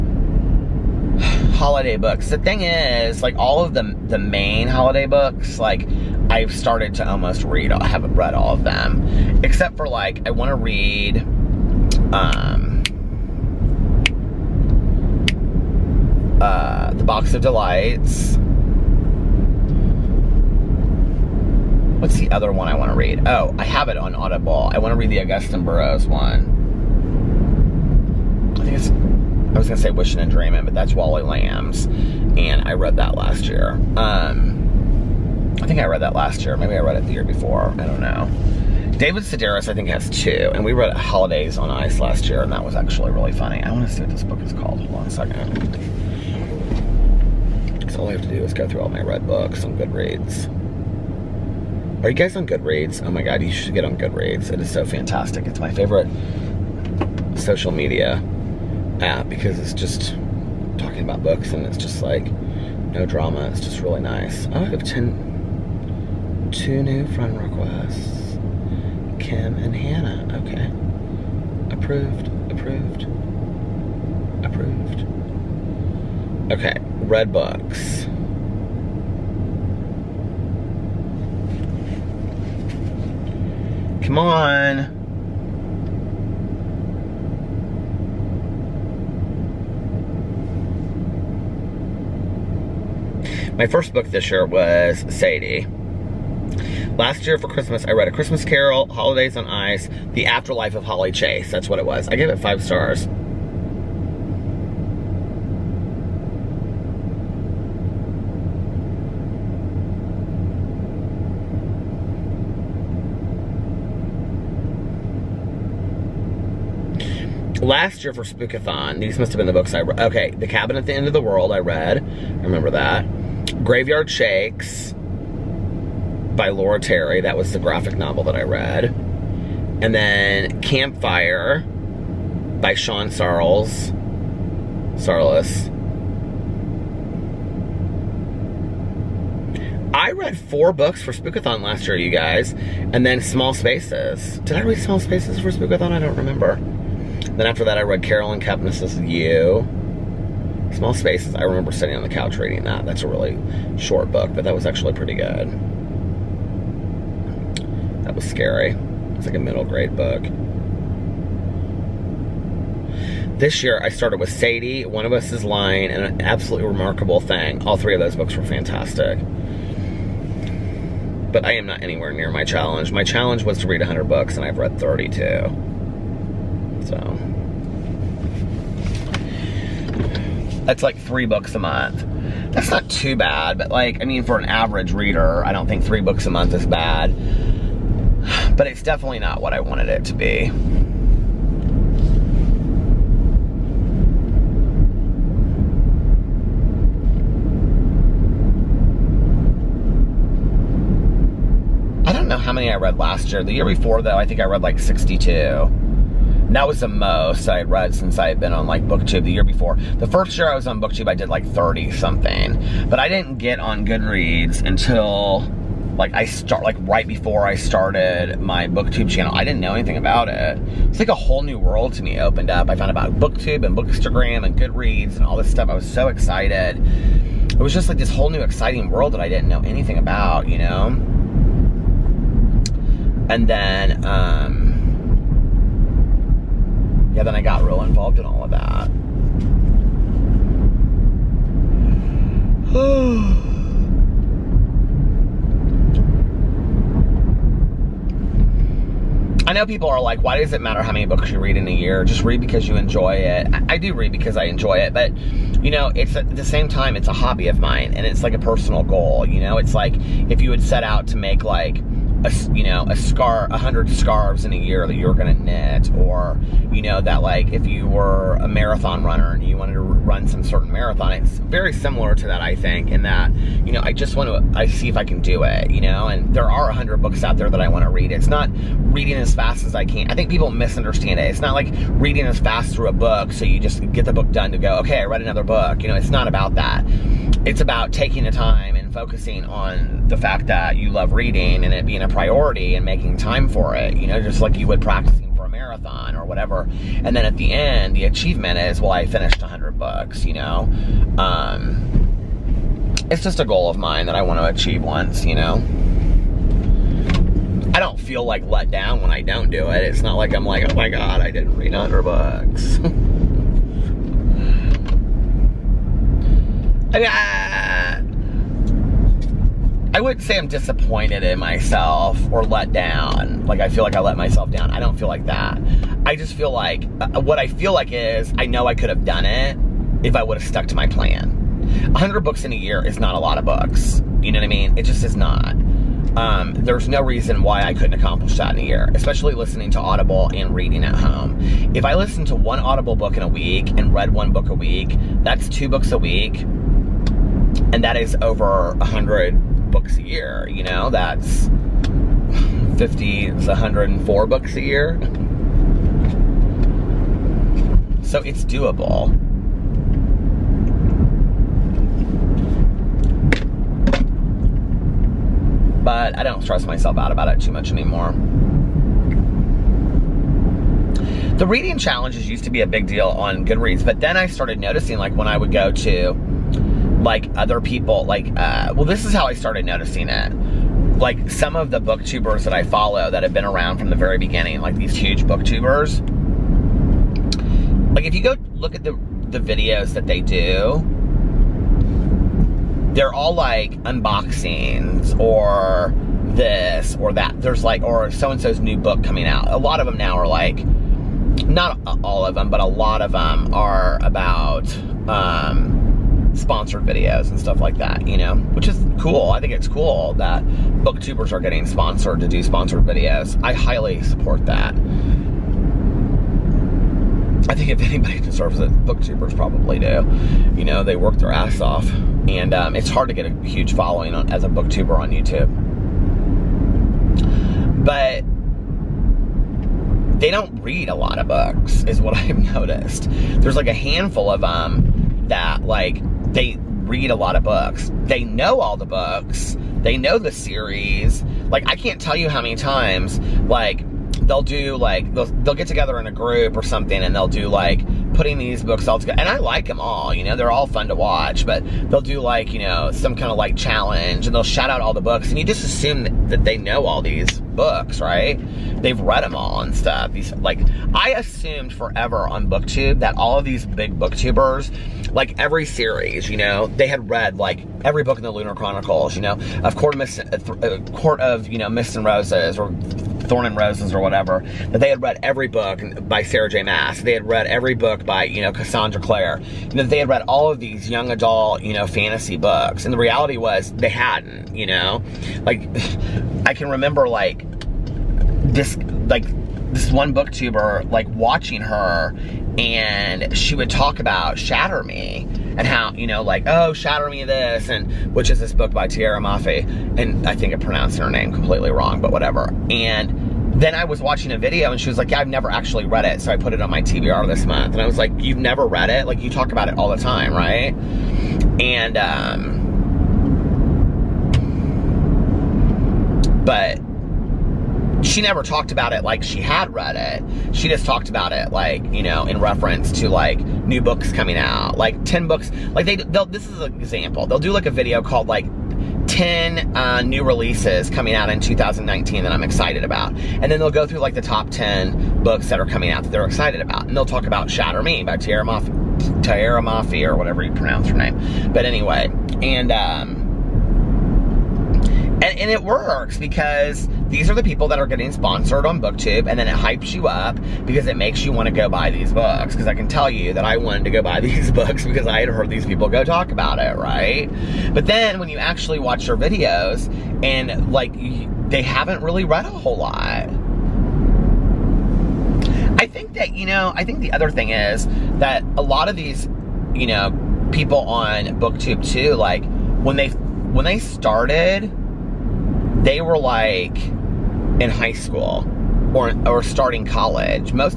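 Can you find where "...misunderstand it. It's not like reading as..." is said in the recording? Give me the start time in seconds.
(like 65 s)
280 s.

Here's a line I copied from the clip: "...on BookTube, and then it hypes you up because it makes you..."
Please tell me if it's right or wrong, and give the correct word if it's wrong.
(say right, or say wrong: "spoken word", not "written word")
right.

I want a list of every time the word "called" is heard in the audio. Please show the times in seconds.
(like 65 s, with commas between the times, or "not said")
44 s, 528 s.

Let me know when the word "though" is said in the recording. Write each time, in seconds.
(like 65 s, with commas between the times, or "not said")
204 s.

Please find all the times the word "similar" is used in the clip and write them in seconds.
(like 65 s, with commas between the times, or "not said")
271 s.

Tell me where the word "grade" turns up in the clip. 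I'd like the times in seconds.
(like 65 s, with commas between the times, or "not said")
159 s.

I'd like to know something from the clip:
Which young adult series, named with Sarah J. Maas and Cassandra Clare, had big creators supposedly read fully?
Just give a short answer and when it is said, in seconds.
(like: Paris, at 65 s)
The Lunar Chronicles, at 468 s.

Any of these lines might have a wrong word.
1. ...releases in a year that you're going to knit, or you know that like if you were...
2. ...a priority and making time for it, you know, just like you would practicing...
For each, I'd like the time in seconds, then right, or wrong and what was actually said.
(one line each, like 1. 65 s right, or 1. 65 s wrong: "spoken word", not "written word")
1. 263 s wrong: "scarves", not "releases"
2. 292 s right.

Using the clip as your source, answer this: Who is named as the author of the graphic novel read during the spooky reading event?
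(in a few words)
Laura Terry.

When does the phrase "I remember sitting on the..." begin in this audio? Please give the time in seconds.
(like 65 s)
151 s.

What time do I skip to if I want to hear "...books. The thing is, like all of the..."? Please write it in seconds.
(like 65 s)
1 s.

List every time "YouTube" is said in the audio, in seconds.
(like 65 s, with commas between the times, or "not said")
425 s.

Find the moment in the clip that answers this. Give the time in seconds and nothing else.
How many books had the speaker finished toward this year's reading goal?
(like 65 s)
174 s.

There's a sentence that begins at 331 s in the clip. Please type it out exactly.
100 books in a year is not a lot of books.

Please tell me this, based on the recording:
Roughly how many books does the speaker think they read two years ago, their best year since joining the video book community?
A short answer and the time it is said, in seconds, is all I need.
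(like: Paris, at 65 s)
62, at 204 s.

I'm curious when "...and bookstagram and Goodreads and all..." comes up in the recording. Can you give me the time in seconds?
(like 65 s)
223 s.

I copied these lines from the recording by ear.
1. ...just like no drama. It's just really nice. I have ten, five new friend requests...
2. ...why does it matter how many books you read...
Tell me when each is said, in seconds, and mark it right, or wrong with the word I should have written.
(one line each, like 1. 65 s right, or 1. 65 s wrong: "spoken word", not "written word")
1. 61 s wrong: "two", not "five"
2. 250 s right.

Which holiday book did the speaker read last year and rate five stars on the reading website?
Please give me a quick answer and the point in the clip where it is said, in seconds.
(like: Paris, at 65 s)
The Afterlife of Holly Chase, at 100 s.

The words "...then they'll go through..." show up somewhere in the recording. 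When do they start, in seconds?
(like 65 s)
533 s.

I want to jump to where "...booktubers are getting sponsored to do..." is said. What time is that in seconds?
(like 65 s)
410 s.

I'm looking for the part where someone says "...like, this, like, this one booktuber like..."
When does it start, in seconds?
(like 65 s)
487 s.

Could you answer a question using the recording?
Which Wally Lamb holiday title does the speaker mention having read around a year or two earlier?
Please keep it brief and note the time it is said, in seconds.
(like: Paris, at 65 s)
Wishing and Dreaming, at 29 s.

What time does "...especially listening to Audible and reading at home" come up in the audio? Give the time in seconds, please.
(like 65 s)
338 s.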